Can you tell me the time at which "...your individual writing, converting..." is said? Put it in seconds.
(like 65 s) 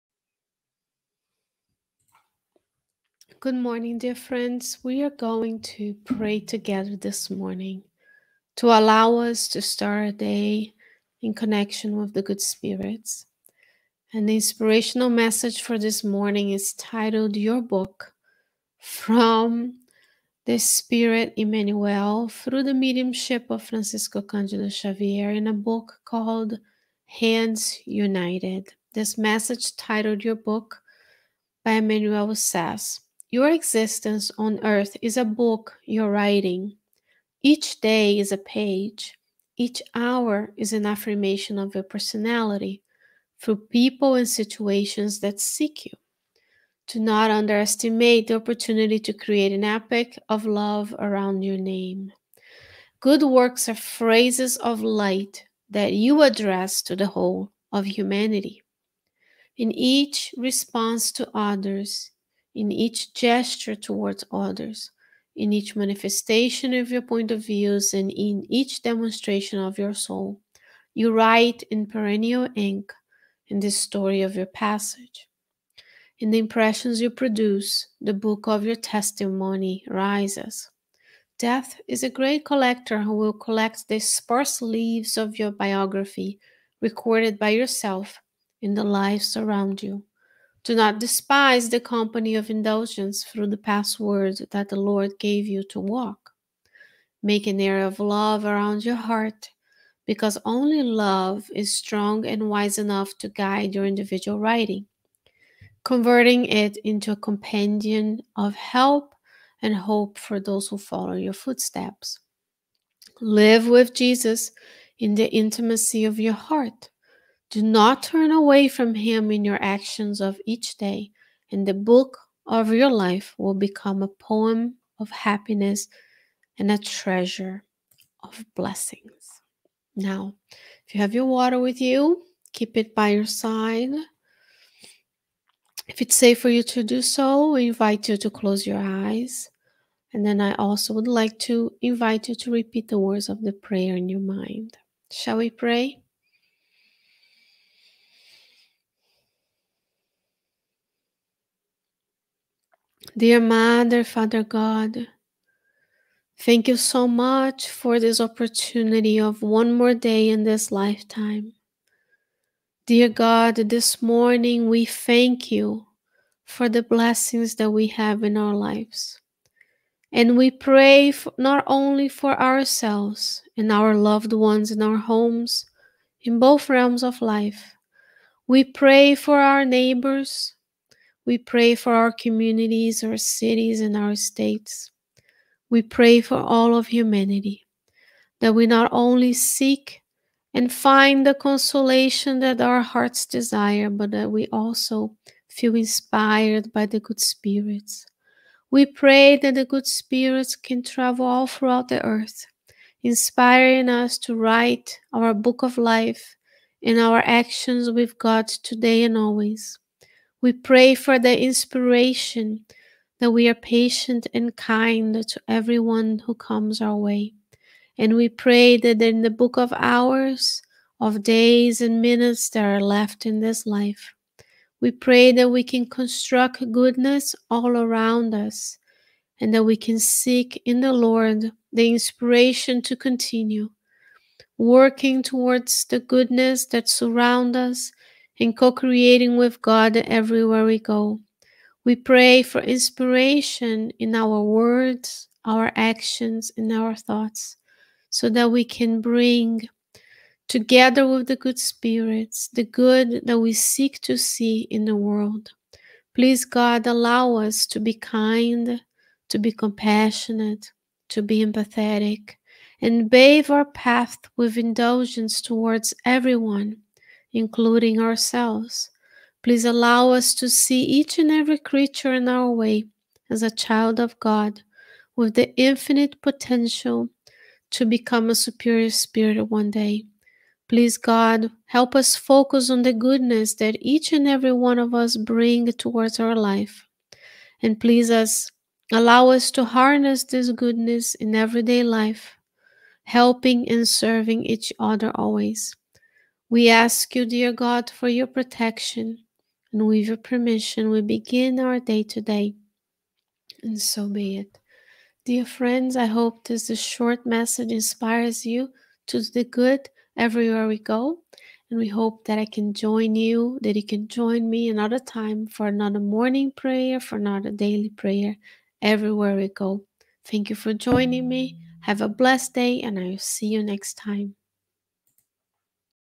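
103 s.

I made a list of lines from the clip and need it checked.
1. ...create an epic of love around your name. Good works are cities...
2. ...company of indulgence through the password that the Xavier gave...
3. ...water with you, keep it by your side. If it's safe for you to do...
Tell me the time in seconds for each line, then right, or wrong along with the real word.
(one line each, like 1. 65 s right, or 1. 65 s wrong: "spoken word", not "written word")
1. 49 s wrong: "phrases", not "cities"
2. 91 s wrong: "Lord", not "Xavier"
3. 131 s right.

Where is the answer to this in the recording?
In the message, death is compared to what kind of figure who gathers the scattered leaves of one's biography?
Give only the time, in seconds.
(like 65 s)
82 s.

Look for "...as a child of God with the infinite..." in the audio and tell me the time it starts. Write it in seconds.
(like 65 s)
273 s.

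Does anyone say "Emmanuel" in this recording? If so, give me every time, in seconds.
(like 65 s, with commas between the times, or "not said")
21 s, 31 s.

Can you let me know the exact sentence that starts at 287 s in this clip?
And please us allow us to harness this goodness in everyday life, helping and serving each other always.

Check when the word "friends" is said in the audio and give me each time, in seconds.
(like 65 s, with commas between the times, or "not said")
4 s, 305 s.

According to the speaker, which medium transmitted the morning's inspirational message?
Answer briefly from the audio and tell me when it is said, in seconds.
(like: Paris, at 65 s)
Francisco Candido Xavier, at 23 s.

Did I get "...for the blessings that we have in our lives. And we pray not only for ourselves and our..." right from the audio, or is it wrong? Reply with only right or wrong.
right.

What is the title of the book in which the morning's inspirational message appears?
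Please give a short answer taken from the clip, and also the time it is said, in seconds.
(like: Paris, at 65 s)
Hands United, at 27 s.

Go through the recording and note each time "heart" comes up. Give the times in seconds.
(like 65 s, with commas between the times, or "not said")
98 s, 116 s, 192 s.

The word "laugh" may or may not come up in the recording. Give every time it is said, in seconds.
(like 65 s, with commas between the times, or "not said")
not said.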